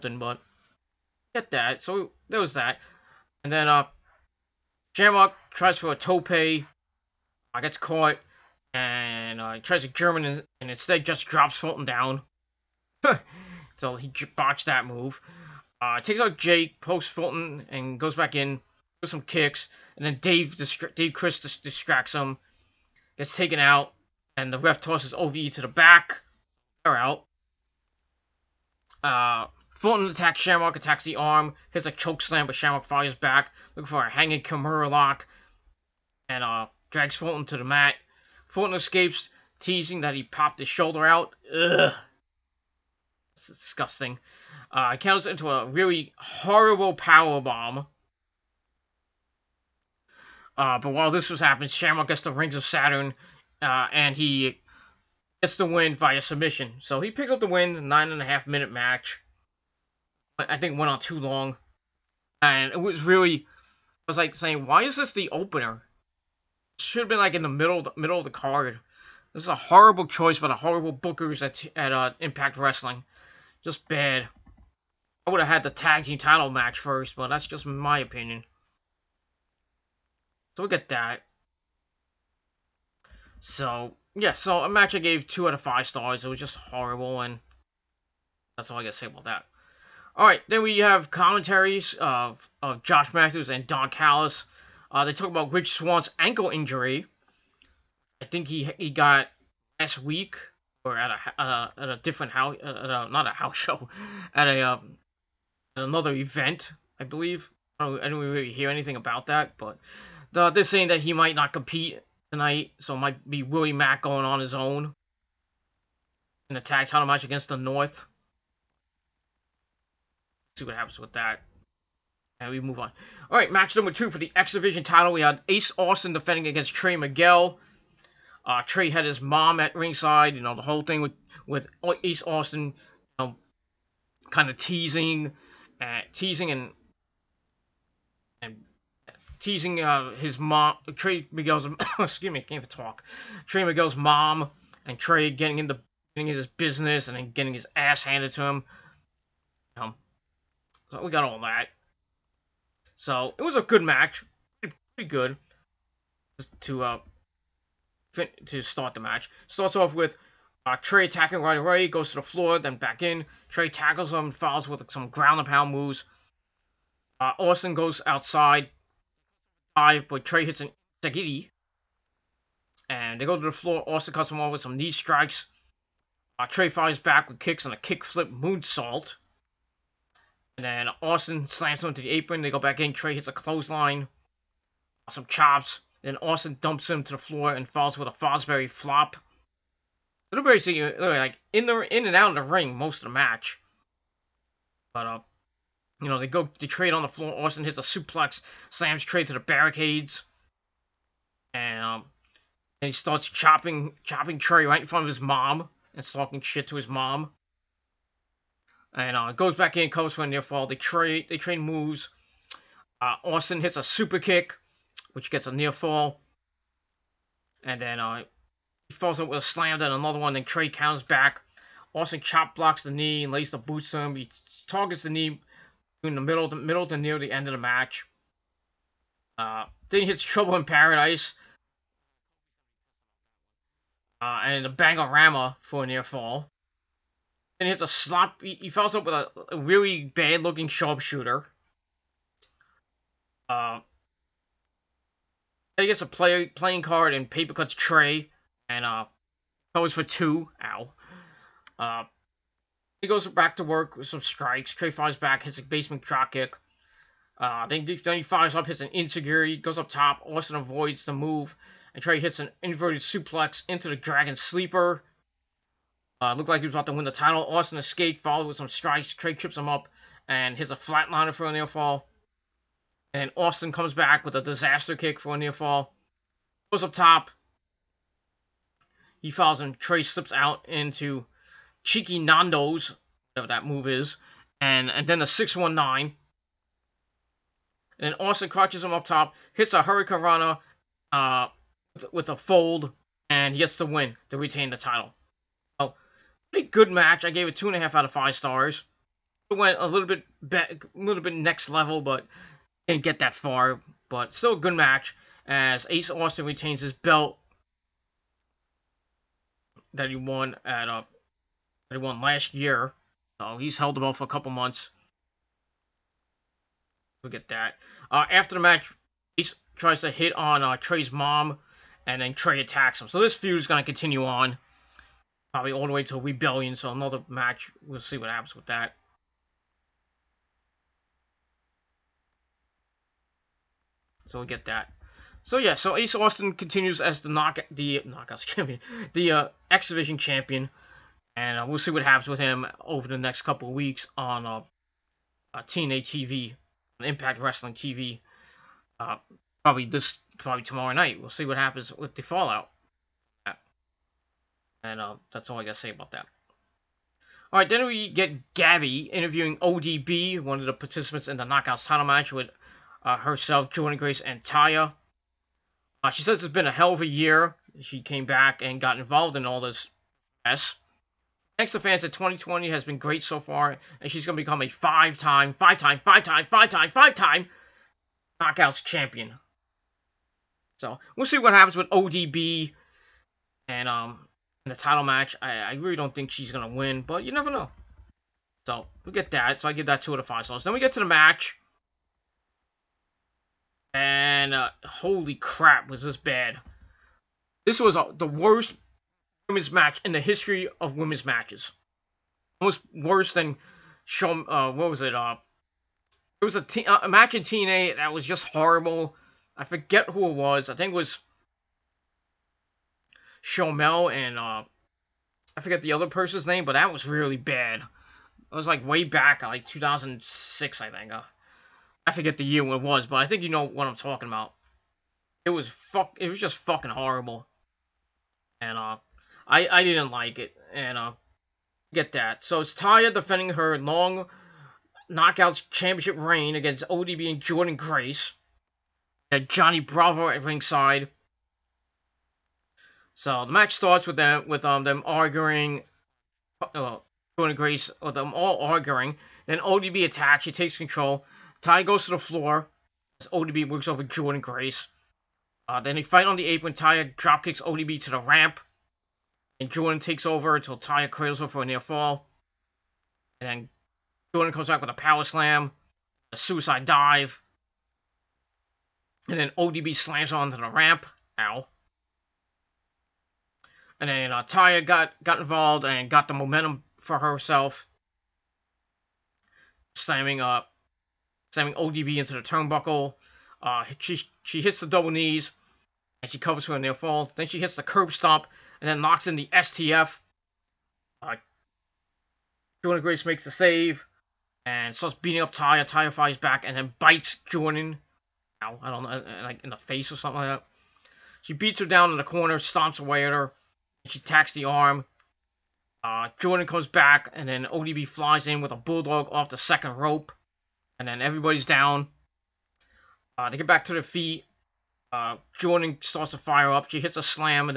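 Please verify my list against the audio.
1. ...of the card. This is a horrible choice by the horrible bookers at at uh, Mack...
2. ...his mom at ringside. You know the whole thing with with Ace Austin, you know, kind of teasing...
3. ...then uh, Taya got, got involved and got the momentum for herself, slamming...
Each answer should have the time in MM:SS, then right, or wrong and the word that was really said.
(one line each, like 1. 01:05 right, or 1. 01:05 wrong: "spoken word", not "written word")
1. 01:08 wrong: "Impact", not "Mack"
2. 02:09 right
3. 07:54 right.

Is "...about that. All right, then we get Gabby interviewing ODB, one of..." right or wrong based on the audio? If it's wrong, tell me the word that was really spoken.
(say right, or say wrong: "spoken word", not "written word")
right.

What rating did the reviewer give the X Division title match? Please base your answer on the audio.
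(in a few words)
2.5 out of 5 stars.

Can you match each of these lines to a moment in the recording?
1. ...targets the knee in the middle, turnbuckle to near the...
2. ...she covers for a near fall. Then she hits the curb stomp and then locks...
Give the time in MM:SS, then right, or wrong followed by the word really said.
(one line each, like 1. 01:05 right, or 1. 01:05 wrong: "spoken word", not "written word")
1. 03:44 wrong: "middle", not "turnbuckle"
2. 08:06 right.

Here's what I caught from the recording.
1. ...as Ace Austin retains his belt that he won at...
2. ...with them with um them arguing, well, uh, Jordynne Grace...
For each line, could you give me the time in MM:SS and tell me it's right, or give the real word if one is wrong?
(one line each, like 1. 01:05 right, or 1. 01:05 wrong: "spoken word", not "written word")
1. 05:05 right
2. 07:24 right.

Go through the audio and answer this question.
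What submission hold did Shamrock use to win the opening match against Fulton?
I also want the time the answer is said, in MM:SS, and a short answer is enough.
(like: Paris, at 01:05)
Rings of Saturn, at 00:52.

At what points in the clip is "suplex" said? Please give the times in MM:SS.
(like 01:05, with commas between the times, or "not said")
03:17, 04:22.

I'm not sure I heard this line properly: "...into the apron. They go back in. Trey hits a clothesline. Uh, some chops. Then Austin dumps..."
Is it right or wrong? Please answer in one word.
right.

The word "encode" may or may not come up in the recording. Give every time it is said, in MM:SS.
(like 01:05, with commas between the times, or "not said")
not said.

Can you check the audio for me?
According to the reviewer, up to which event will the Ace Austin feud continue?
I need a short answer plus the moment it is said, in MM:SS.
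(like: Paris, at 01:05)
Rebellion, at 05:26.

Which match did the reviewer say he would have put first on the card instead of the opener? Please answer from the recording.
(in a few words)
Tag team title match.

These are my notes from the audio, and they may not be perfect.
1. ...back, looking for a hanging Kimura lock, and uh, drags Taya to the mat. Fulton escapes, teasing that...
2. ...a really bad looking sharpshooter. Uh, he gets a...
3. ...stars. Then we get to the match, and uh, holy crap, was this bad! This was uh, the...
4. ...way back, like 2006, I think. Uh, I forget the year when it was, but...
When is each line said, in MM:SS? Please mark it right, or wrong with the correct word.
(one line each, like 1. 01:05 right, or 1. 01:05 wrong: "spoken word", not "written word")
1. 00:33 wrong: "Fulton", not "Taya"
2. 03:59 right
3. 06:30 right
4. 06:58 right.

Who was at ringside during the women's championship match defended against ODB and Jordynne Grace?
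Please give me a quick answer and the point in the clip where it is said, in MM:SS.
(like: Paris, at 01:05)
Johnny Bravo, at 07:19.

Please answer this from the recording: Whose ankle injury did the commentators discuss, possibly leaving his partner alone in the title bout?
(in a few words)
Rich Swann.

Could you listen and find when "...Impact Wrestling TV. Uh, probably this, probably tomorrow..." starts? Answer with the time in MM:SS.
05:46.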